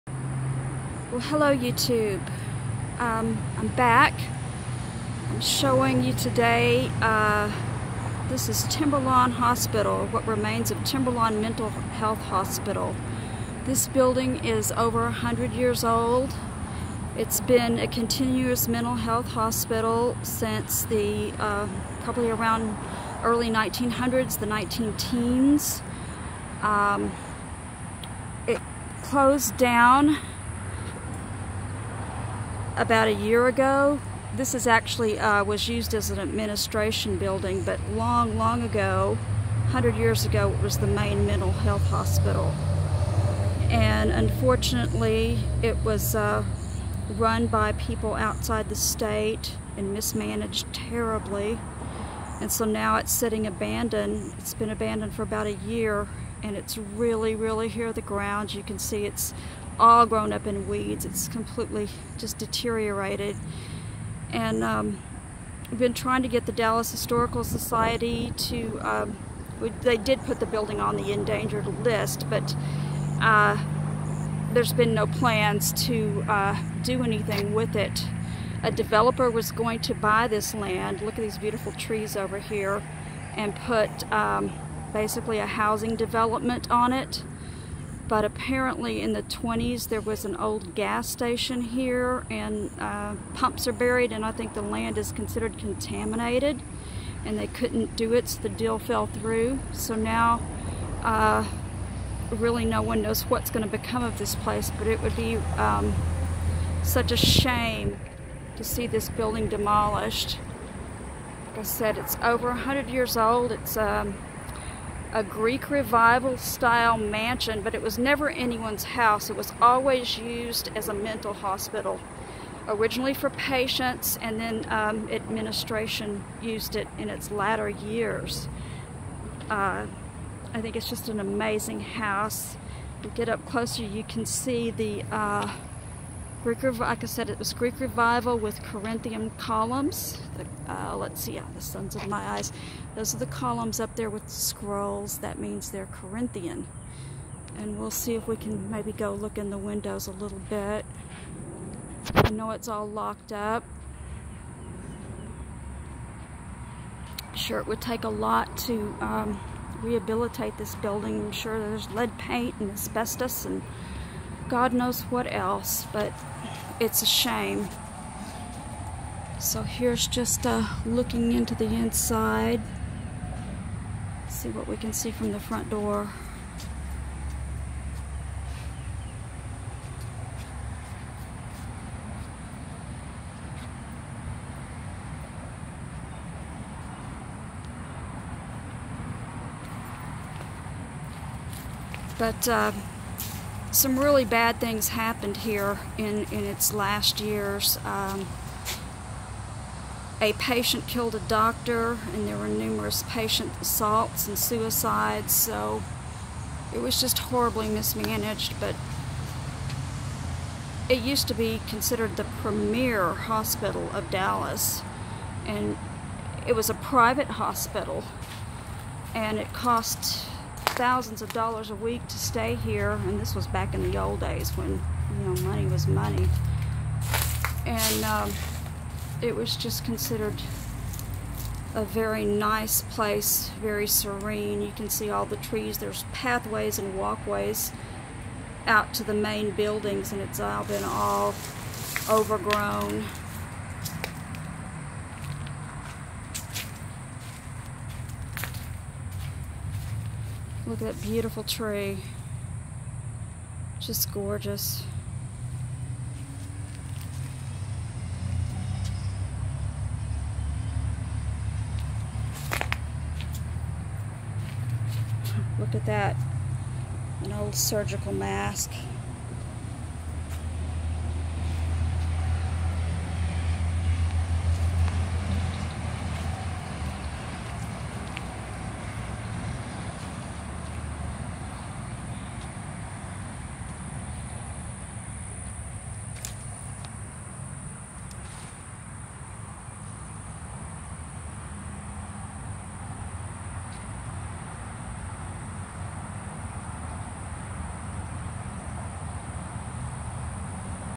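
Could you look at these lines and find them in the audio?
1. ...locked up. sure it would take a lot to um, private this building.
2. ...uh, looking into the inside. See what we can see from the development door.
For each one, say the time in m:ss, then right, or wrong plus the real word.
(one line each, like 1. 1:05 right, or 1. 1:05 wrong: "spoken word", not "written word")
1. 2:32 wrong: "rehabilitate", not "private"
2. 2:50 wrong: "front", not "development".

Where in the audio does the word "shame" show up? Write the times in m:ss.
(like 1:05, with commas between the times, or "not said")
1:47, 2:47.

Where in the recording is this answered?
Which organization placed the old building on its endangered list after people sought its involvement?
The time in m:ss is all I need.
1:06.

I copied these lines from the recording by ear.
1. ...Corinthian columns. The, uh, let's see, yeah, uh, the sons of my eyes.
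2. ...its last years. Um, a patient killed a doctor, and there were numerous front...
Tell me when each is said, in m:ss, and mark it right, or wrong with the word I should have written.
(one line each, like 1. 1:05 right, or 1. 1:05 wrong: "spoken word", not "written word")
1. 2:18 right
2. 3:16 wrong: "patient", not "front".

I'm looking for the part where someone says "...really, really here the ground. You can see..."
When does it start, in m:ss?
0:56.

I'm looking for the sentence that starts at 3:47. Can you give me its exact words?
And um, it was just considered a very nice place, very serene.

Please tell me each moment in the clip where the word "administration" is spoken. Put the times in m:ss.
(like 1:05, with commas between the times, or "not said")
0:36, 2:05.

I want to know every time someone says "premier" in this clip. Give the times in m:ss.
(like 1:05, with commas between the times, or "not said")
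3:32.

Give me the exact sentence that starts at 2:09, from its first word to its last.
Uh, I think it's just an amazing house.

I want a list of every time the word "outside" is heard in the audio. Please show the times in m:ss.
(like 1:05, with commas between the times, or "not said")
0:48.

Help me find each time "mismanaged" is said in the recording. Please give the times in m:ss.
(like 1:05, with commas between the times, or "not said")
0:49, 3:27.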